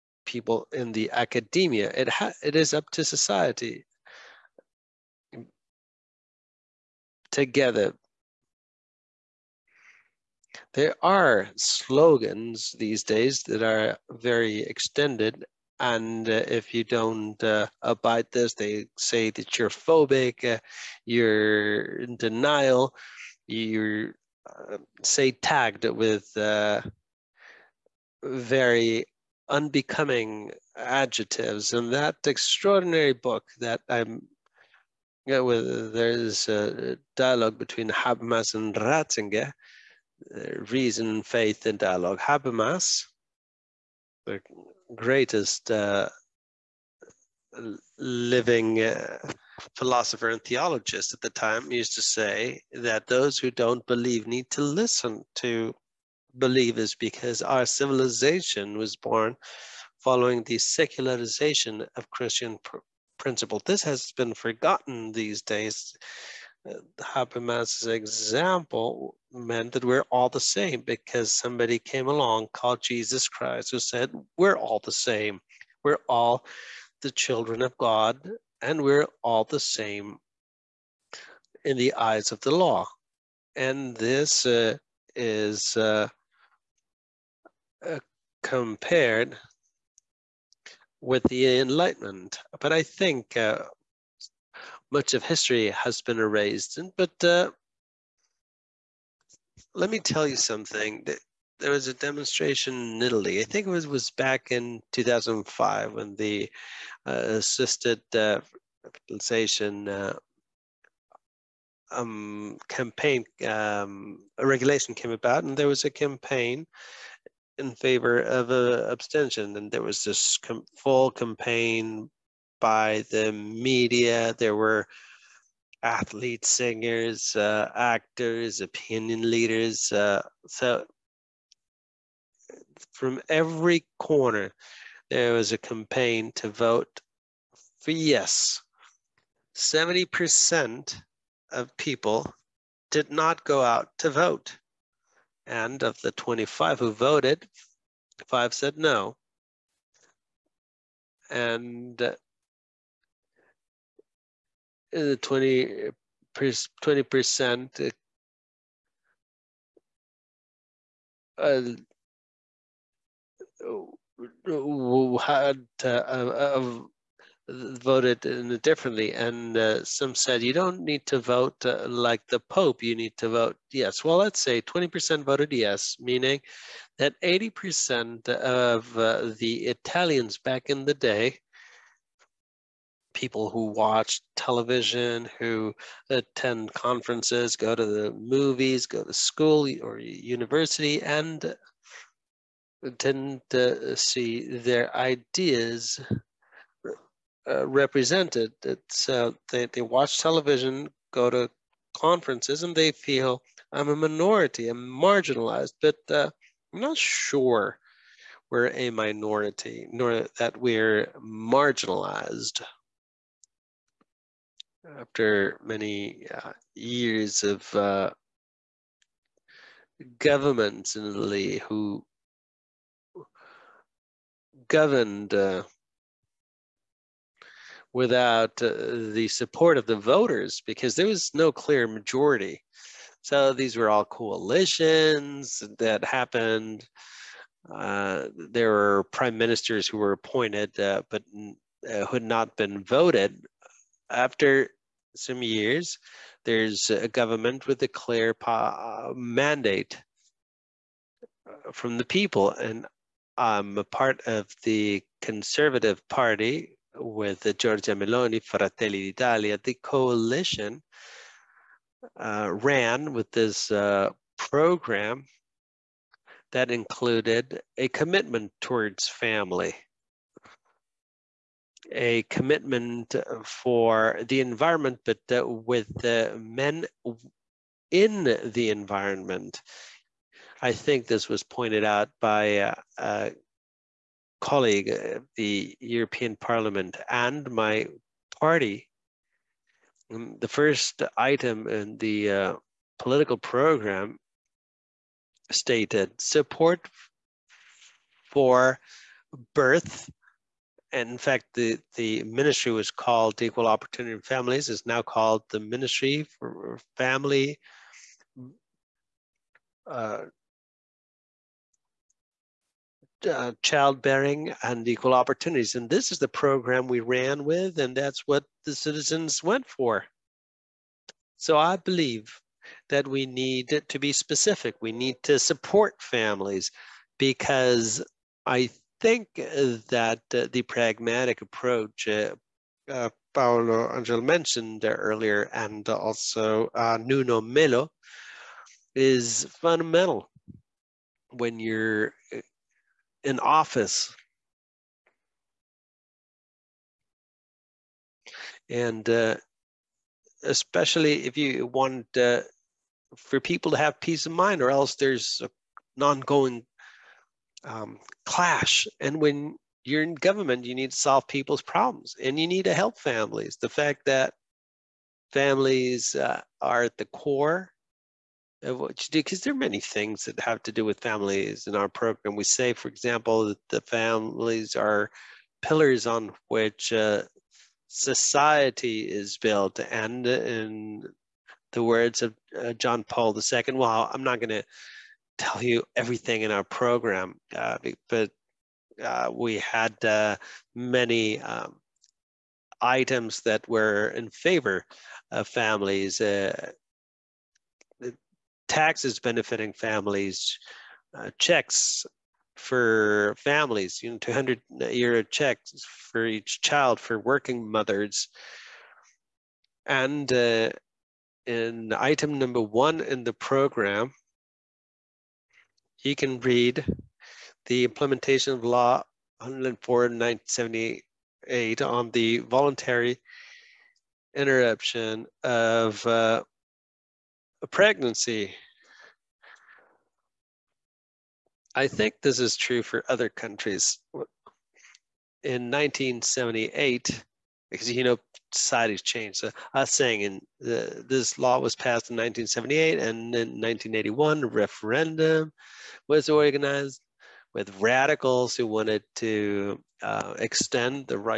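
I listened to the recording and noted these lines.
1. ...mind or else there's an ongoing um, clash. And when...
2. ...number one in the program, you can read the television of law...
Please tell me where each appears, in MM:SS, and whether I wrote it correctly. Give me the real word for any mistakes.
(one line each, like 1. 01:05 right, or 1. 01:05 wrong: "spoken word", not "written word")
1. 05:54 right
2. 06:52 wrong: "implementation", not "television".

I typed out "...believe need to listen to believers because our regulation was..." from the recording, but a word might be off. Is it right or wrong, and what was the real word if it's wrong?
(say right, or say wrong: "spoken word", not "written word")
wrong: "civilization", not "regulation".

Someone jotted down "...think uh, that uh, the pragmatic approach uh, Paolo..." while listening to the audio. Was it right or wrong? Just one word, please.
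right.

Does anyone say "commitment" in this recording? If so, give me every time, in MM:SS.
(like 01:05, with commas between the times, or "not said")
04:27, 04:32.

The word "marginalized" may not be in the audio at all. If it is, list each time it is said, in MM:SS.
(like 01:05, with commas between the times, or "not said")
03:24, 03:31.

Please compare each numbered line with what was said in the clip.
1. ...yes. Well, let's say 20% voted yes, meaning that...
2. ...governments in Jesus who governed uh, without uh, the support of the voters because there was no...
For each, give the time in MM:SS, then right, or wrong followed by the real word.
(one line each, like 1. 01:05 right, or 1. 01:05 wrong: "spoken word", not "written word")
1. 02:53 right
2. 03:40 wrong: "Italy", not "Jesus".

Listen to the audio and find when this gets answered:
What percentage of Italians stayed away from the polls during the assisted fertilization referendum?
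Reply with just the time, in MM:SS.
02:19.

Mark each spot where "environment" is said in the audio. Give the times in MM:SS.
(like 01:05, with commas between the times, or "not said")
04:34, 04:38.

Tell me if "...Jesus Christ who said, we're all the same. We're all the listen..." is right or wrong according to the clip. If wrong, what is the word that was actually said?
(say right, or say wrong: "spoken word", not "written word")
wrong: "children", not "listen".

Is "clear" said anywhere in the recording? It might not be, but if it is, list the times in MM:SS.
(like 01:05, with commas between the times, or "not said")
03:51, 04:07.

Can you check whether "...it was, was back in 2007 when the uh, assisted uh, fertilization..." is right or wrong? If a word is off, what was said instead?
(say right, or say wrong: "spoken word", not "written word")
wrong: "2005", not "2007".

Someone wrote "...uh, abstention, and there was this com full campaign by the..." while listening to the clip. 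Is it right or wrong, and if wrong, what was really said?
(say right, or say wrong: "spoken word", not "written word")
right.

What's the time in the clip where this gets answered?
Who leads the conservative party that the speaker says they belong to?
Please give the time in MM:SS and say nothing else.
04:17.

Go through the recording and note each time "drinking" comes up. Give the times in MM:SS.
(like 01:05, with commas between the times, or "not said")
not said.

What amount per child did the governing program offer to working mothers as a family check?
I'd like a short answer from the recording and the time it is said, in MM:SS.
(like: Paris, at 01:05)
200 euros, at 06:44.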